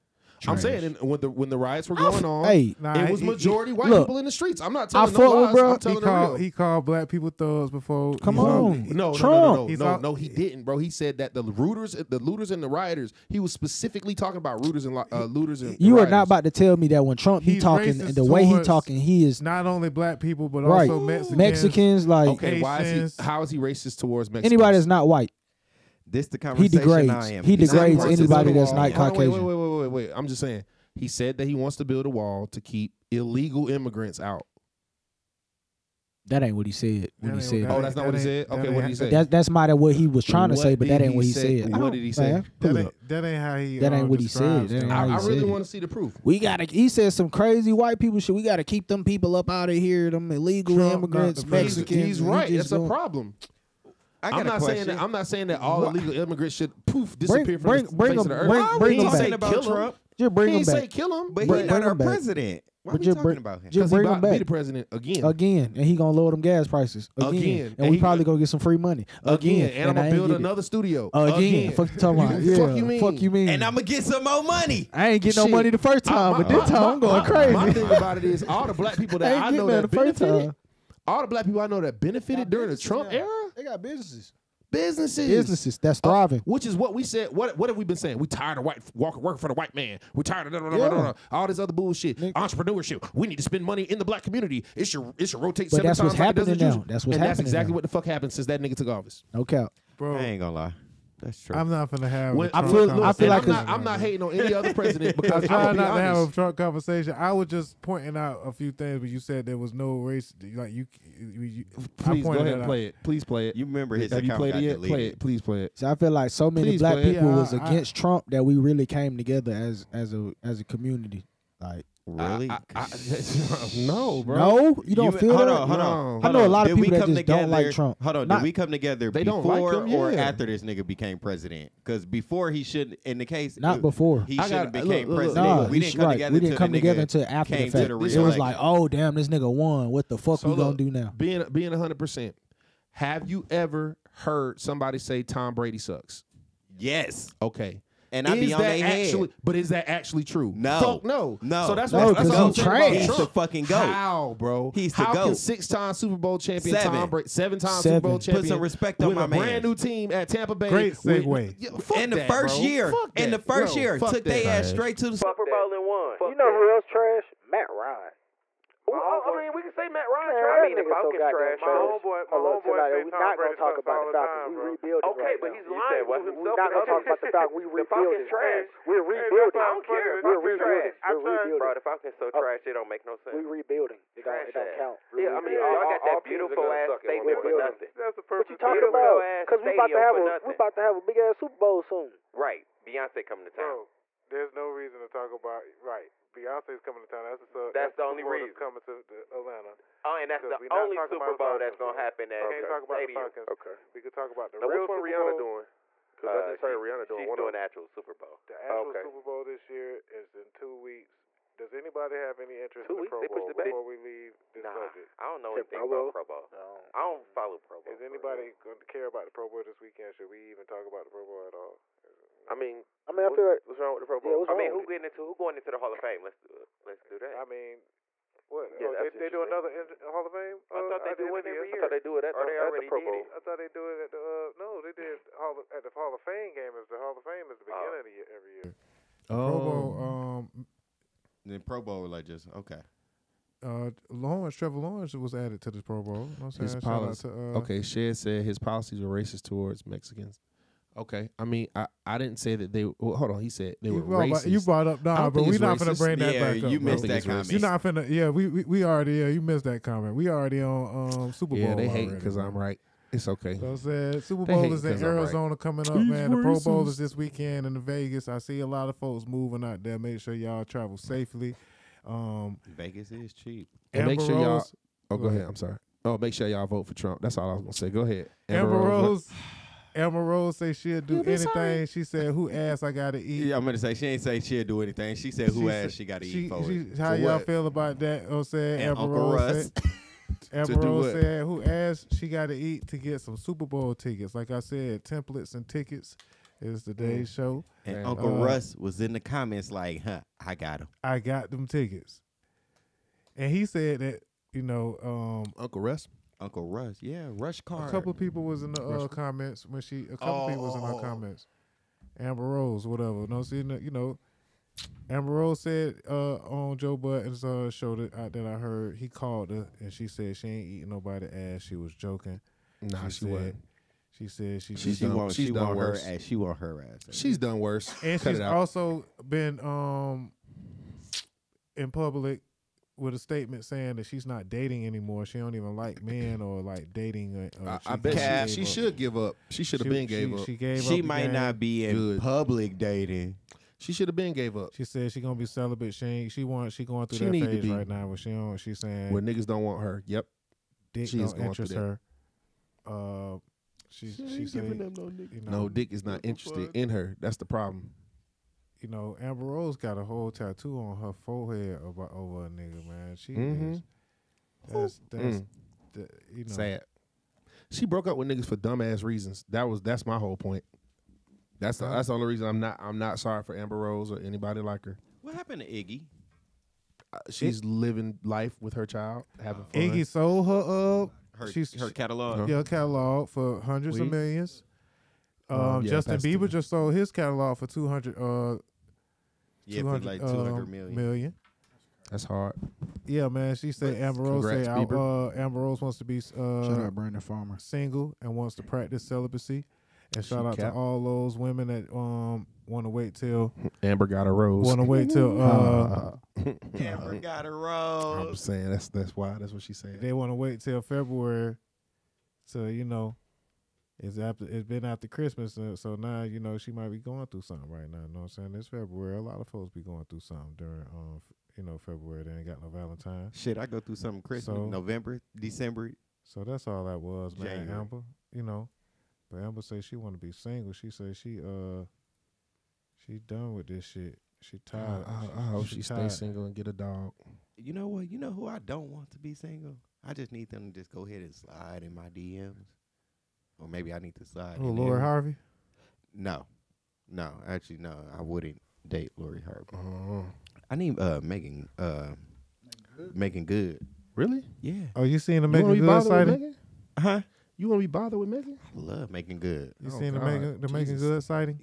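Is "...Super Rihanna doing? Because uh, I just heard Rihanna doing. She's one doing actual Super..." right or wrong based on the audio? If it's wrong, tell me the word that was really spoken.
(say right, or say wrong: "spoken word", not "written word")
right.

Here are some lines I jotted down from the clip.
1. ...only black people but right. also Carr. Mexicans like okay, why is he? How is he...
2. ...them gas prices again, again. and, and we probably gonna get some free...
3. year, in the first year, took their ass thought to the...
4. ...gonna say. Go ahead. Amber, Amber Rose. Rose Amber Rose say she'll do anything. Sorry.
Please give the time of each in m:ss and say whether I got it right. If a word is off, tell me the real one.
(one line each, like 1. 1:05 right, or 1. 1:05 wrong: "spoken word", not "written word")
1. 0:19 wrong: "Mexicans", not "Carr"
2. 1:06 right
3. 2:42 wrong: "straight", not "thought"
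4. 4:37 right.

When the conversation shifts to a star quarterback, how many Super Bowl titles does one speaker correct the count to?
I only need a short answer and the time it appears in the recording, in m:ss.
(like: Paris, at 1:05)
7, at 2:37.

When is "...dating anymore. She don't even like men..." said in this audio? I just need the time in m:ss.
5:34.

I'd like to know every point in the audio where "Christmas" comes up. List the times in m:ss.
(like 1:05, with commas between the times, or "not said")
6:55, 7:04.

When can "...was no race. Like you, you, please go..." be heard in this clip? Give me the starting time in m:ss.
1:49.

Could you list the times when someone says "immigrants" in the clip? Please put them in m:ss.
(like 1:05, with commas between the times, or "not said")
0:33, 0:50, 0:56.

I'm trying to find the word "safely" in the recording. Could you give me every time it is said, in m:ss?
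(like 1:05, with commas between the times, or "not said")
4:30.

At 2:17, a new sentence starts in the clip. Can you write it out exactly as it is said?
The it was like, oh damn, this nigga won.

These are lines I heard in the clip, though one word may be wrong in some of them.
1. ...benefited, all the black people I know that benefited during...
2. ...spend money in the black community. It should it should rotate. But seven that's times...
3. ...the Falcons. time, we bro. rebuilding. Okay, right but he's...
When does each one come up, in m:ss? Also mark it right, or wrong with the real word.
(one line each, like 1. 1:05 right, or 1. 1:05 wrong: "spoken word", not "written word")
1. 1:19 right
2. 1:33 right
3. 2:54 right.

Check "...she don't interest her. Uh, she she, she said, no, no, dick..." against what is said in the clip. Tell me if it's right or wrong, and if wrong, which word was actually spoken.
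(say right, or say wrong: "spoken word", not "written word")
right.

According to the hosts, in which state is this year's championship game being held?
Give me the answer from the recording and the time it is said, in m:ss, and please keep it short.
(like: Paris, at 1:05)
Arizona, at 4:25.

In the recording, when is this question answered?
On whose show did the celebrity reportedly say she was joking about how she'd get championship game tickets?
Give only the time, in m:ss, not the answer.
5:16.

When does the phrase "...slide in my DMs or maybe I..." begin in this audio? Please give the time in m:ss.
7:21.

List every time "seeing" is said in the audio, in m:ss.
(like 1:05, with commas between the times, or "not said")
7:35.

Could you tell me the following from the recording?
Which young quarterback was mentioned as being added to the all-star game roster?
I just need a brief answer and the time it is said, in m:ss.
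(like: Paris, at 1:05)
Trevor Lawrence, at 4:04.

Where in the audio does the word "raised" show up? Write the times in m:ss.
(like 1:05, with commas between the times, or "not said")
not said.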